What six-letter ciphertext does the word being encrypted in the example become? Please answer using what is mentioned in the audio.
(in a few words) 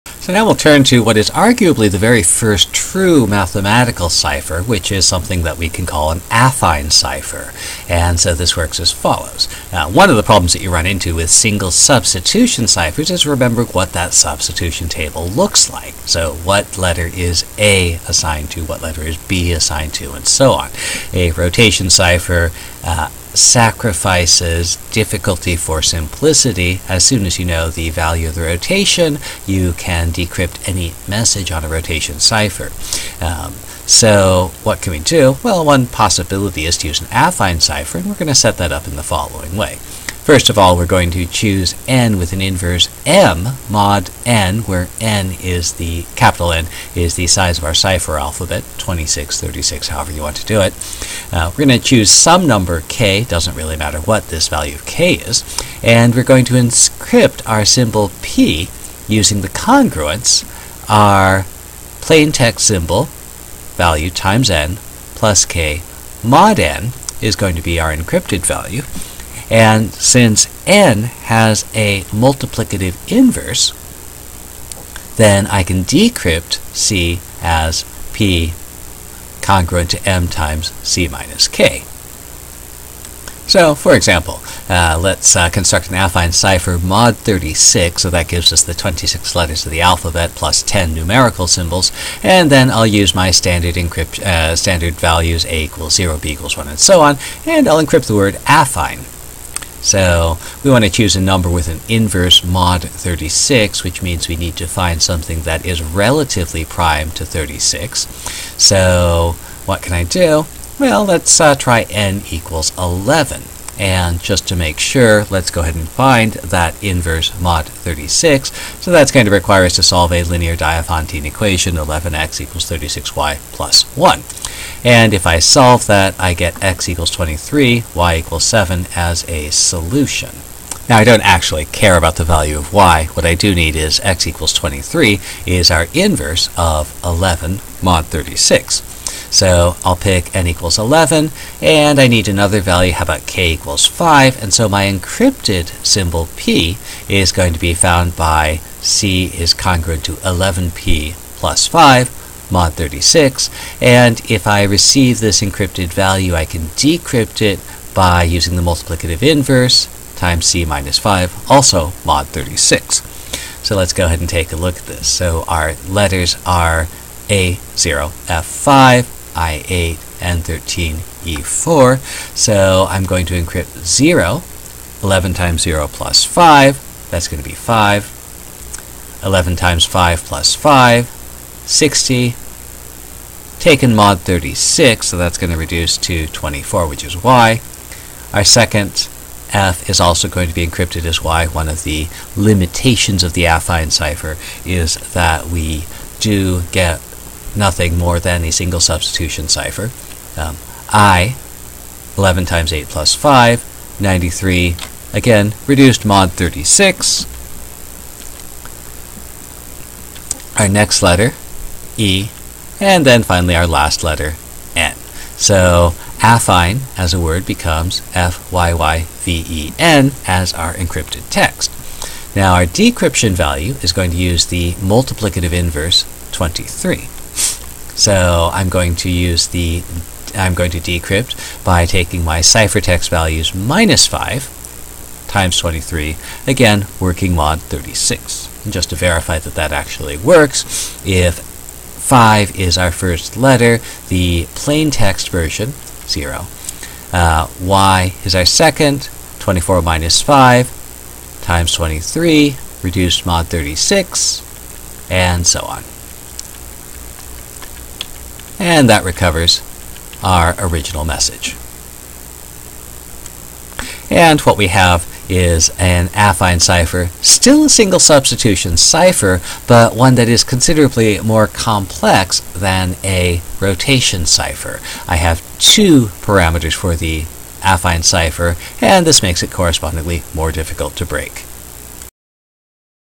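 FYYVEN.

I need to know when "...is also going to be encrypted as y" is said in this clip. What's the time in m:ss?
3:09.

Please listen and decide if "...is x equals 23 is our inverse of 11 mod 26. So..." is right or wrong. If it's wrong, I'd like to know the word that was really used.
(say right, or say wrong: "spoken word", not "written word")
wrong: "36", not "26".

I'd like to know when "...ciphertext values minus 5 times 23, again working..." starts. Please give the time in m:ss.
3:52.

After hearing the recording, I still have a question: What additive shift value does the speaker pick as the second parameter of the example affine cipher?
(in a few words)
5.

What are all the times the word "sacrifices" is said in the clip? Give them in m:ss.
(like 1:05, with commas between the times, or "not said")
0:23.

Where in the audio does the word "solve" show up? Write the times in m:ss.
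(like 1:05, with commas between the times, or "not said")
1:59, 2:05.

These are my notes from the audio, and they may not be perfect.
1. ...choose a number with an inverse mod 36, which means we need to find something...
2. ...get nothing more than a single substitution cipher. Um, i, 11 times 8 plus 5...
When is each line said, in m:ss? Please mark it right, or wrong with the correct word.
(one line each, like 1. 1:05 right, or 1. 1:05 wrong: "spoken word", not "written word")
1. 1:40 right
2. 3:16 right.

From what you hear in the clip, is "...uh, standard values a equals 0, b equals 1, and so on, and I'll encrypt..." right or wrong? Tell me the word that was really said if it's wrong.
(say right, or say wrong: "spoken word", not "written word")
right.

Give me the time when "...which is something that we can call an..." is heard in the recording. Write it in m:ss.
0:04.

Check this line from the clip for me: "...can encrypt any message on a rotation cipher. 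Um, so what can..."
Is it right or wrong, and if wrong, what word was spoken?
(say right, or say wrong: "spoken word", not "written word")
wrong: "decrypt", not "encrypt".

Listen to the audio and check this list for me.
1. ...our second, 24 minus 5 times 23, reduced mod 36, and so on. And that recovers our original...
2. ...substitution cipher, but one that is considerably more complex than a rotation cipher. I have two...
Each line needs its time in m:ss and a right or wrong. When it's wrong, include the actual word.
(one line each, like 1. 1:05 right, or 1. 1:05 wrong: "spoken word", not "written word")
1. 4:08 right
2. 4:27 right.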